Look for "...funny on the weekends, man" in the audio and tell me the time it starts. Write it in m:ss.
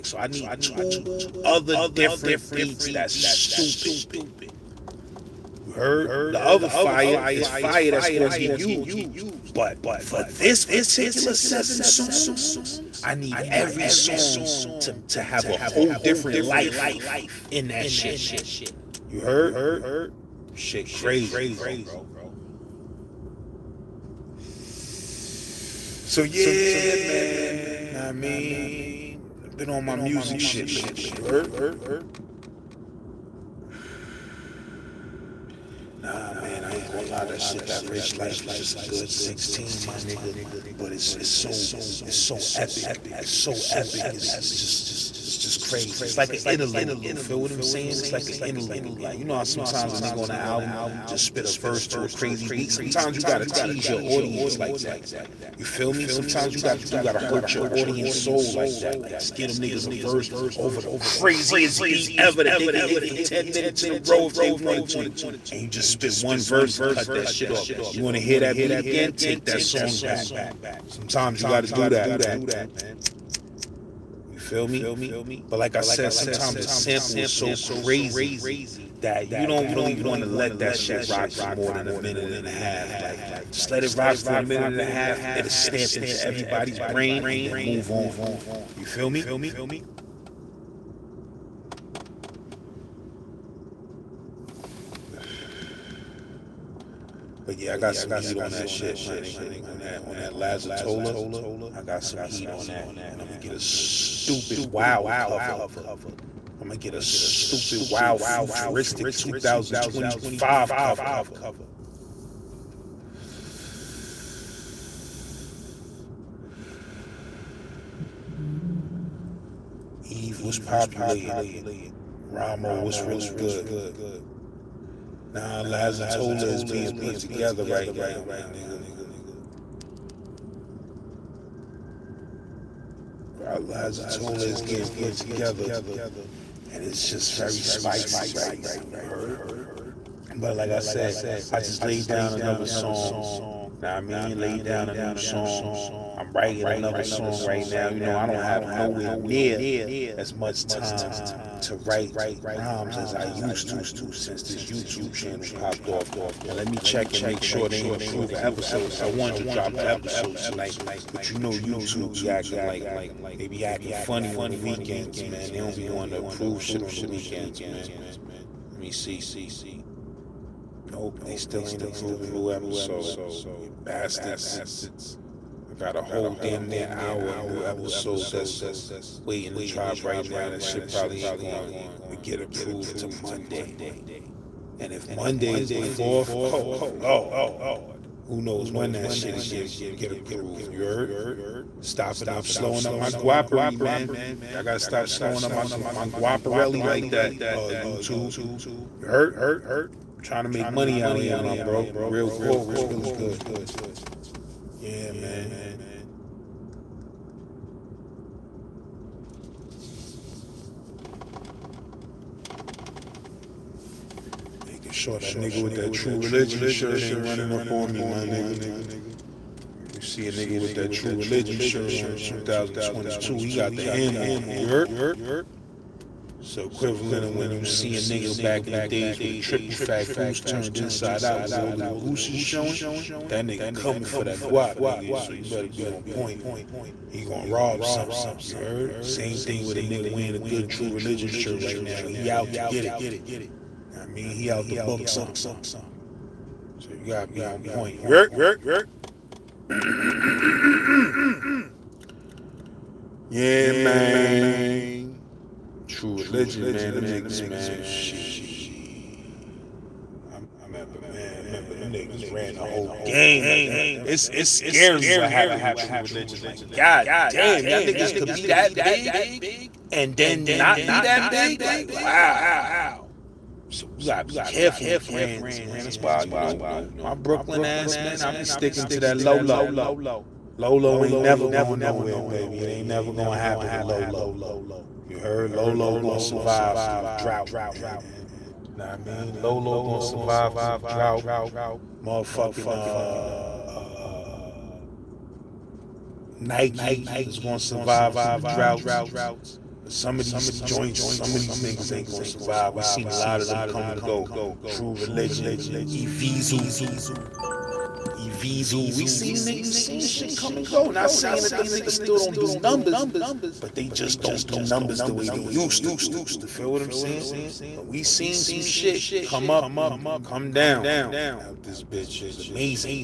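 2:43.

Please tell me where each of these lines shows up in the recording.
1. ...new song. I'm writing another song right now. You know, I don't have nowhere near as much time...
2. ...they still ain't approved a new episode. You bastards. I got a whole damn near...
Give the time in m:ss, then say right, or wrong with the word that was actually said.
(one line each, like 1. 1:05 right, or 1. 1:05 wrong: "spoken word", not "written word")
1. 2:24 right
2. 2:51 right.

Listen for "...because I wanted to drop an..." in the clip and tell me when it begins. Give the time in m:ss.
2:38.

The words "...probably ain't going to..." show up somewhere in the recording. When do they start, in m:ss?
3:00.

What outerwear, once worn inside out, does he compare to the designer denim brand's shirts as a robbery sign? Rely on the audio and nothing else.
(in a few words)
Triple fat goose.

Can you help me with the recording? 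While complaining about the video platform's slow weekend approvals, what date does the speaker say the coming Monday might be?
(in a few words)
the 4th.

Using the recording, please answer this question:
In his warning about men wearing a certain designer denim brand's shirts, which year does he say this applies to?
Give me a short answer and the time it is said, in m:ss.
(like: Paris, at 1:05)
2022, at 3:42.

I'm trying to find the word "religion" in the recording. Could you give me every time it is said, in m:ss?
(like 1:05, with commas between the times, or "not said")
3:36, 3:41, 4:00, 4:16, 4:25, 5:04.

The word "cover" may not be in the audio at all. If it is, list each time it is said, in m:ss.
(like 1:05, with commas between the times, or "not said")
1:45, 1:50.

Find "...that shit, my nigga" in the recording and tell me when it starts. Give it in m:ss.
1:38.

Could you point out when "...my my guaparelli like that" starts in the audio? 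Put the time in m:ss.
3:15.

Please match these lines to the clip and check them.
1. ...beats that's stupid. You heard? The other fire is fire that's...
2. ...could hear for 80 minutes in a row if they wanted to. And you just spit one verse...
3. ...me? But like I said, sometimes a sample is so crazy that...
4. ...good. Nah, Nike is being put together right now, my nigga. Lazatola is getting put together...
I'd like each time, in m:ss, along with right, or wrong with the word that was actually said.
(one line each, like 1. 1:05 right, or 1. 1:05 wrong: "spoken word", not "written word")
1. 0:02 right
2. 1:02 wrong: "10", not "80"
3. 1:14 right
4. 2:03 wrong: "Lazatola", not "Nike".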